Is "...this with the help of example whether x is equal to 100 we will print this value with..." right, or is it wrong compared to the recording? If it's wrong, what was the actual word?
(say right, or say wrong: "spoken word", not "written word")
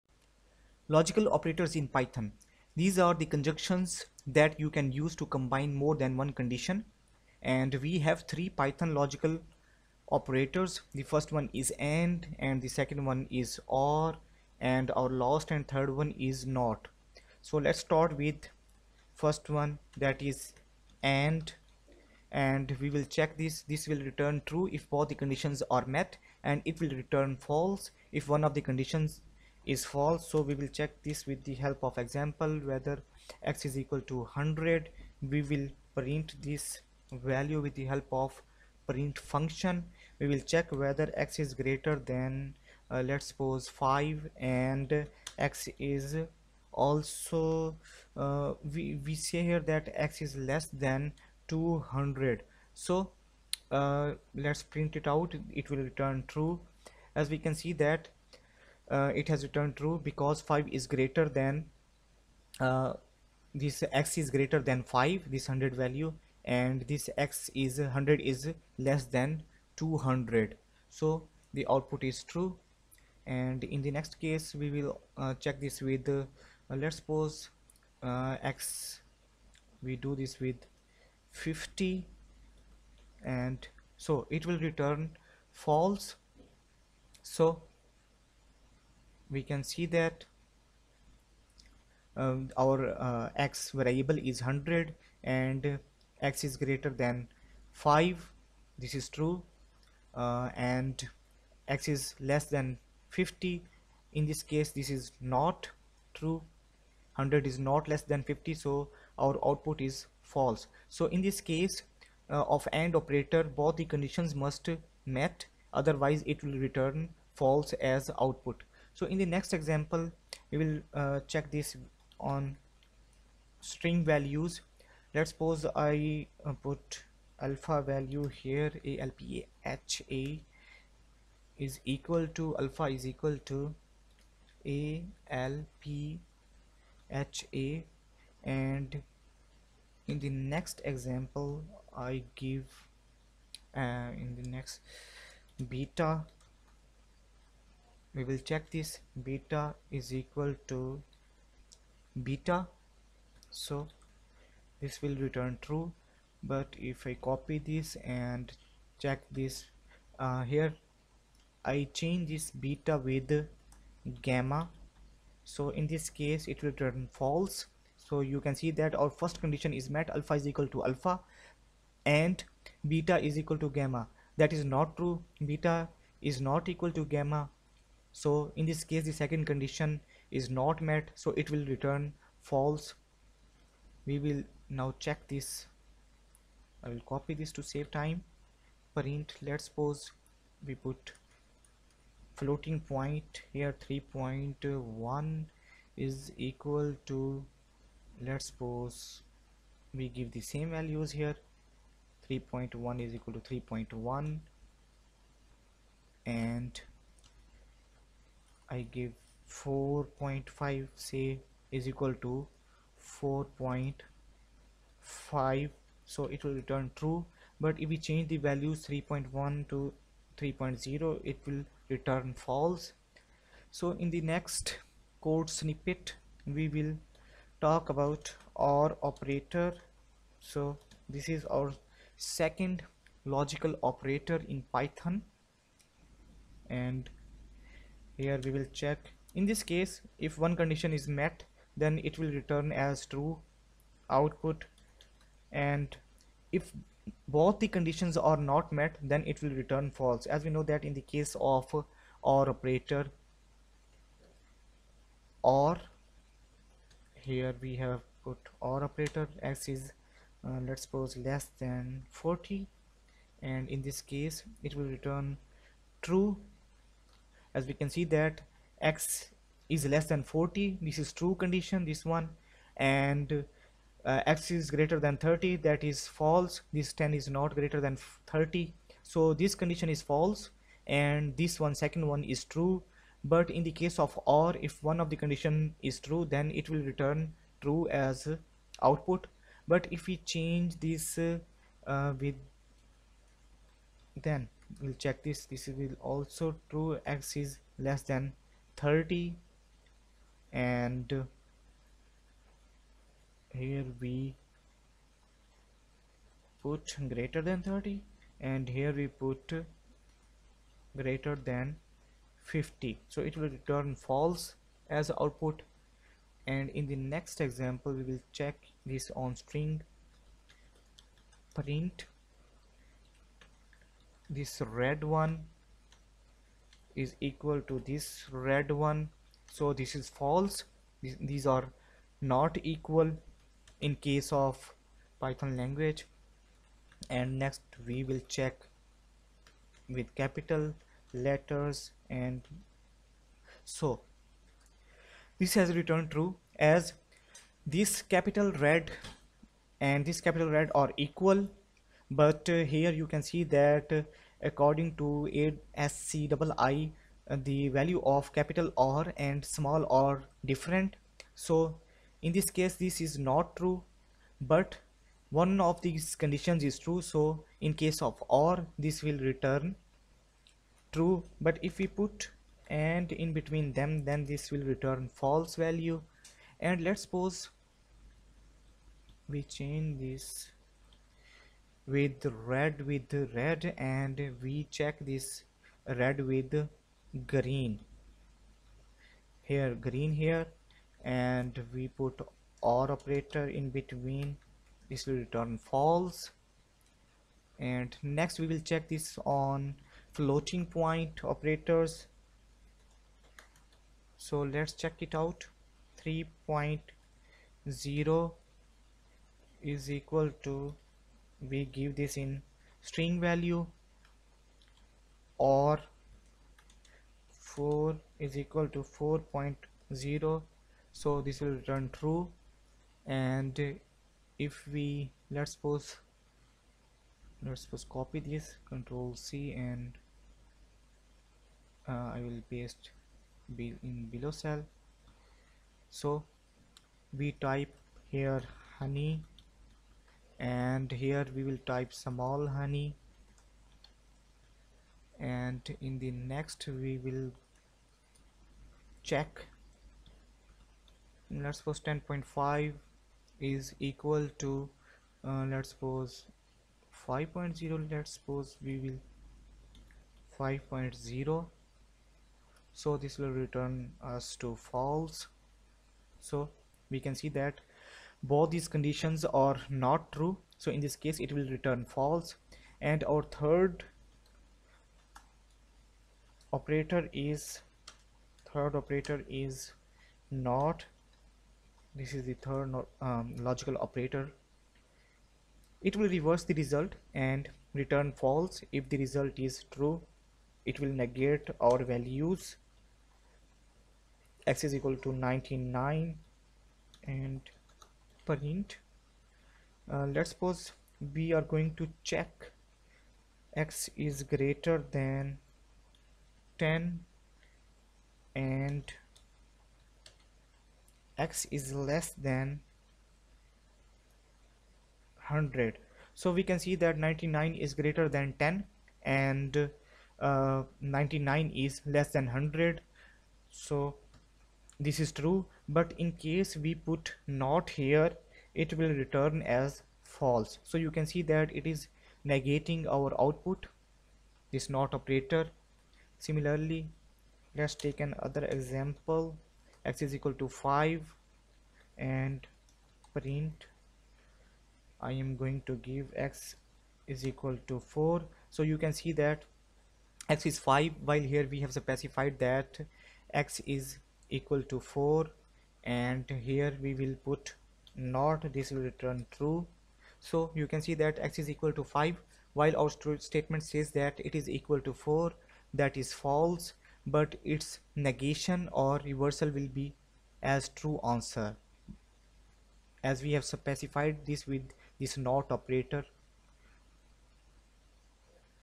right.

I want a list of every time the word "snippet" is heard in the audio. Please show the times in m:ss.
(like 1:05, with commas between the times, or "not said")
3:45.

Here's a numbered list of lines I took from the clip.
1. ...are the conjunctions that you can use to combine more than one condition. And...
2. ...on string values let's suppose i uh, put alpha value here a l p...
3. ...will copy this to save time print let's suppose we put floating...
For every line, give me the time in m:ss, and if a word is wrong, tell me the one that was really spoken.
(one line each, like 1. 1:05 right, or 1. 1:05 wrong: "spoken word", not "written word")
1. 0:02 right
2. 2:02 right
3. 3:06 right.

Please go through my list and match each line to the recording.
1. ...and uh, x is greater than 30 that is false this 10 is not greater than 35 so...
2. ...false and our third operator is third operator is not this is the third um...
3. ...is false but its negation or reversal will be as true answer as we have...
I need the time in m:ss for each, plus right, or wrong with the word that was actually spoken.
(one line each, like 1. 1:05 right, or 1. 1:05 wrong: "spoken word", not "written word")
1. 4:32 wrong: "30", not "35"
2. 7:51 right
3. 9:26 right.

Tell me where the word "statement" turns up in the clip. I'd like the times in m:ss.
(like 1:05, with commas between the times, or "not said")
9:23.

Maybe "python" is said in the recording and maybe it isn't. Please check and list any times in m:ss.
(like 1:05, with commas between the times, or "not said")
0:01, 0:08, 3:54, 5:35.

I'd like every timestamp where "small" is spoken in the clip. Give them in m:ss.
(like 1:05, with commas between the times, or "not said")
5:59, 7:21.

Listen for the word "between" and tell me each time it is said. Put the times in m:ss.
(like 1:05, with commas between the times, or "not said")
6:13, 6:33.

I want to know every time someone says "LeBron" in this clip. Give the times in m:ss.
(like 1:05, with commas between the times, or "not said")
not said.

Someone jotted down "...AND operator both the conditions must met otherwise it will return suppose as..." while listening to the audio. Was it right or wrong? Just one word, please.
wrong.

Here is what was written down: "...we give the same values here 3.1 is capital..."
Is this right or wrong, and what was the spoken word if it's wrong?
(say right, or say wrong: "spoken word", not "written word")
wrong: "equal", not "capital".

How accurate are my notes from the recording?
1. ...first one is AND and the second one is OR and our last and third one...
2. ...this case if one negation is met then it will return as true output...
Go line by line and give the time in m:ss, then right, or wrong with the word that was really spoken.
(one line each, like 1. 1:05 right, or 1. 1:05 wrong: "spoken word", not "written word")
1. 0:11 right
2. 3:59 wrong: "condition", not "negation".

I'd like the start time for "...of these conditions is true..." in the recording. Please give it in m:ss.
6:05.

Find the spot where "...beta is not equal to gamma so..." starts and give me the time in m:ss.
2:55.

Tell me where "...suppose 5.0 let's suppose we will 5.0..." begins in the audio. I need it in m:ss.
7:35.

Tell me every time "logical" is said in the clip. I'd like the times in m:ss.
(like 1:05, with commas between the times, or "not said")
0:00, 0:08, 3:53, 8:03.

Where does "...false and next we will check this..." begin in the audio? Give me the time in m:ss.
6:35.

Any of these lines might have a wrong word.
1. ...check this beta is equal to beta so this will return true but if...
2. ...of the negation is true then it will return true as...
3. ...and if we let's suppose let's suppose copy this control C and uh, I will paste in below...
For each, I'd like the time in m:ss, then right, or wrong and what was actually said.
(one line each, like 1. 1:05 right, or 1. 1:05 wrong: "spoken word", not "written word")
1. 2:28 right
2. 4:44 wrong: "condition", not "negation"
3. 7:03 right.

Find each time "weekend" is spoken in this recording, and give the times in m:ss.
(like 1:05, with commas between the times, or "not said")
not said.